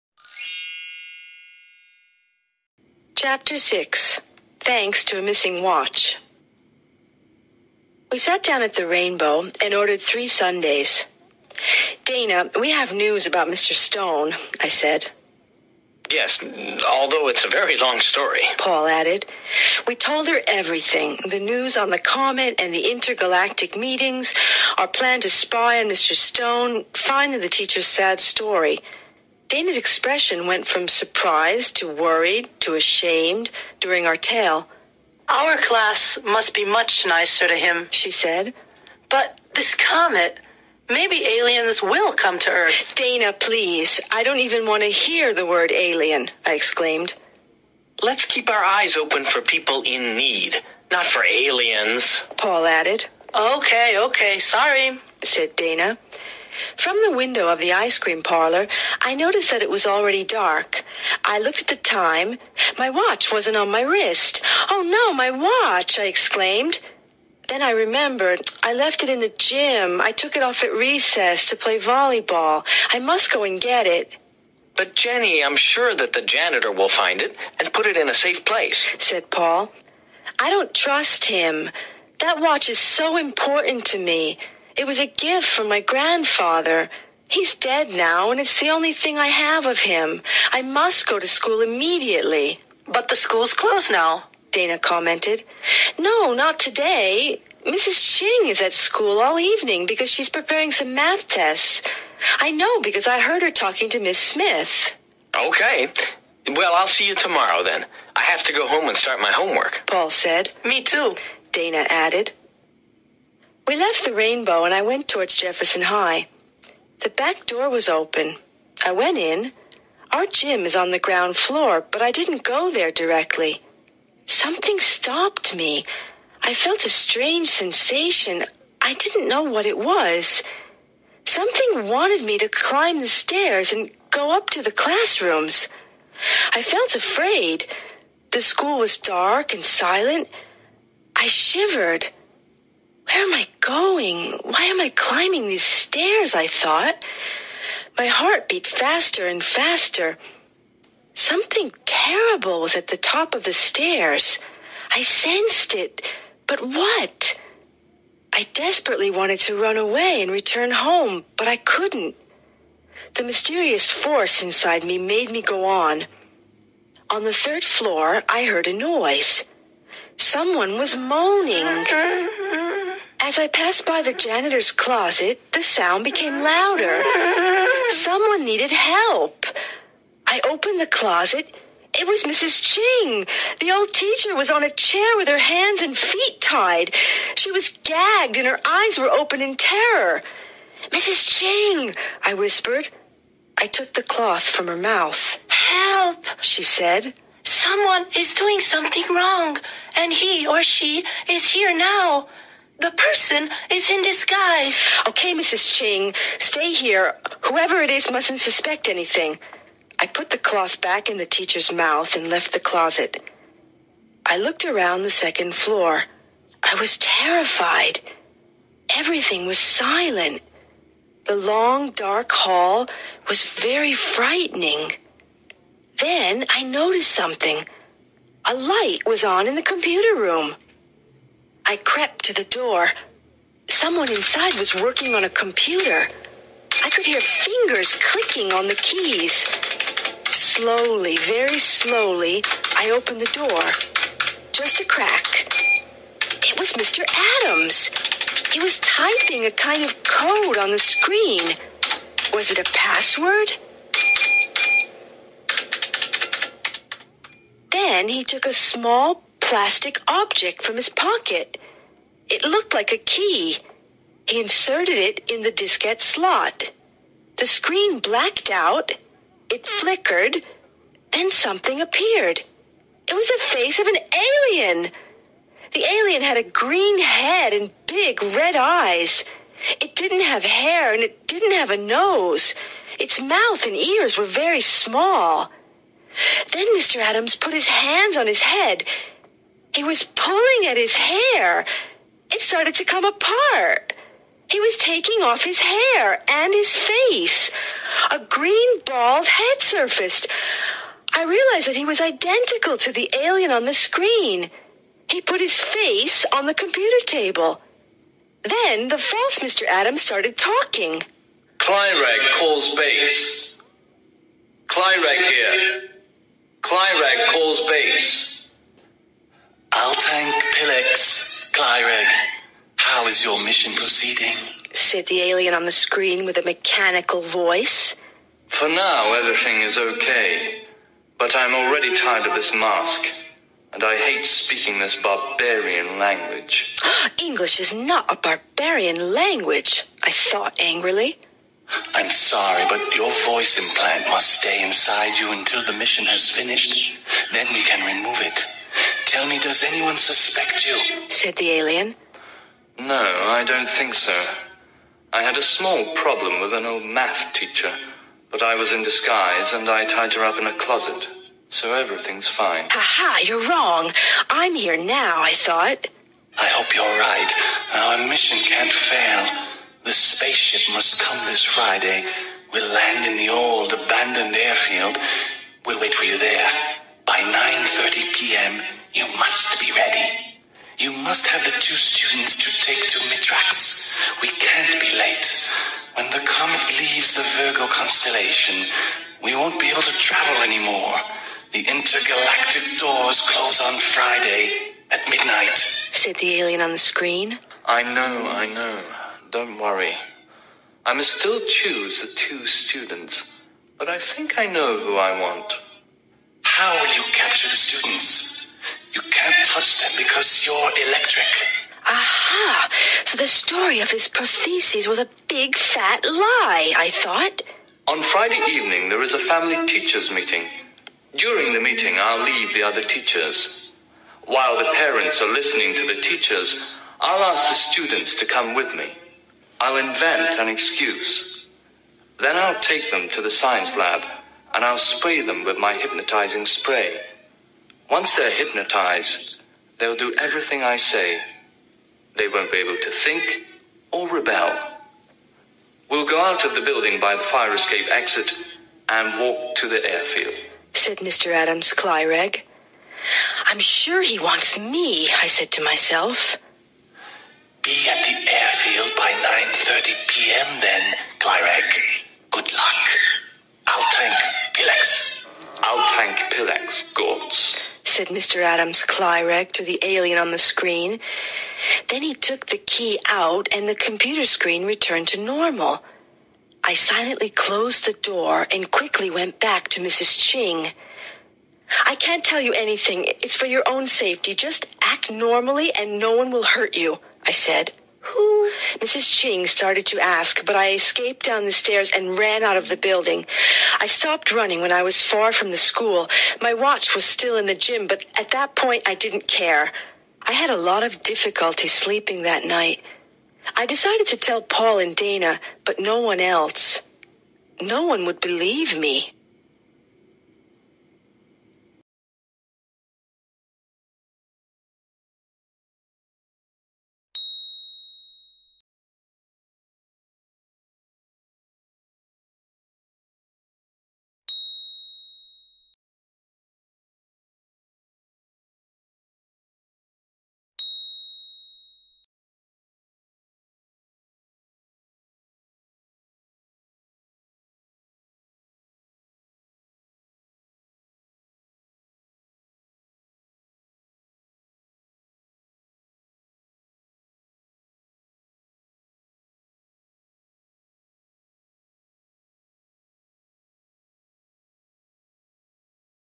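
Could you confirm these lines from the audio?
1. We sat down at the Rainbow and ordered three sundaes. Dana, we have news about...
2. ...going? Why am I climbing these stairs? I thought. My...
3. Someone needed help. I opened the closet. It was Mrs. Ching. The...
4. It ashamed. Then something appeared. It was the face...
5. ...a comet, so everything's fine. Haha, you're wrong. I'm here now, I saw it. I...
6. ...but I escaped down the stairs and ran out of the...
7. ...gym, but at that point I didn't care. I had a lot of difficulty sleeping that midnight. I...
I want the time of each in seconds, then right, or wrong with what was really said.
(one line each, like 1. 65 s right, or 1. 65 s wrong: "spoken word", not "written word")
1. 8 s right
2. 143 s right
3. 177 s right
4. 269 s wrong: "flickered", not "ashamed"
5. 360 s wrong: "closet", not "comet"
6. 490 s right
7. 497 s wrong: "night", not "midnight".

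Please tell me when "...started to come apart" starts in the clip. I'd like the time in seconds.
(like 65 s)
292 s.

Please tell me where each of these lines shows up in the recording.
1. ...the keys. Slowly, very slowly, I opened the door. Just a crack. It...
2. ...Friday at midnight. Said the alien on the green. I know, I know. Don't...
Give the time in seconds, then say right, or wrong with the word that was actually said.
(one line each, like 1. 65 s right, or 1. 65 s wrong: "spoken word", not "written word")
1. 238 s right
2. 393 s wrong: "screen", not "green".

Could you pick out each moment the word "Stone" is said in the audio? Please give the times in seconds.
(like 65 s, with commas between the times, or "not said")
13 s, 26 s.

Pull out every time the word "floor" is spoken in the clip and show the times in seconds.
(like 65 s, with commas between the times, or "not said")
121 s, 167 s, 215 s.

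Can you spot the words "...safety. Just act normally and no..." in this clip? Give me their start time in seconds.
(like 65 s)
483 s.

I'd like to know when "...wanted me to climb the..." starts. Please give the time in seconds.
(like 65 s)
131 s.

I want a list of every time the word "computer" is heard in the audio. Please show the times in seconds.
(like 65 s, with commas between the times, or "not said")
229 s, 235 s, 306 s, 473 s.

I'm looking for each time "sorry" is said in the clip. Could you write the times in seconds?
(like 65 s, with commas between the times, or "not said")
54 s, 342 s.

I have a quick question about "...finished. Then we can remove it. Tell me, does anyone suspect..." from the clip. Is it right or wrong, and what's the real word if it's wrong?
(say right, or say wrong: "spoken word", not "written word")
right.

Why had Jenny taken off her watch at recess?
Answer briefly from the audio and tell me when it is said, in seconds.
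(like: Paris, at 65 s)
To play volleyball, at 71 s.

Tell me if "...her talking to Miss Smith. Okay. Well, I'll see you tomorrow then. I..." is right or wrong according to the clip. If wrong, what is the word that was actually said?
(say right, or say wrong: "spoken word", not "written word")
right.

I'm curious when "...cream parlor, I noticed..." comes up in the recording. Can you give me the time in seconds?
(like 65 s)
57 s.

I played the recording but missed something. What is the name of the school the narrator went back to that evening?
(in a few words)
Jefferson High.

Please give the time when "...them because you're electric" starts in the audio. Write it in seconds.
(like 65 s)
409 s.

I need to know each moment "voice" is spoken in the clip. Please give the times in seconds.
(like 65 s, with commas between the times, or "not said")
327 s, 343 s.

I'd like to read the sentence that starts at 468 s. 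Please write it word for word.
Adams Clyrek to the alien on the screen.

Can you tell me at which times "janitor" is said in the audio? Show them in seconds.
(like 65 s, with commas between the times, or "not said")
76 s, 174 s.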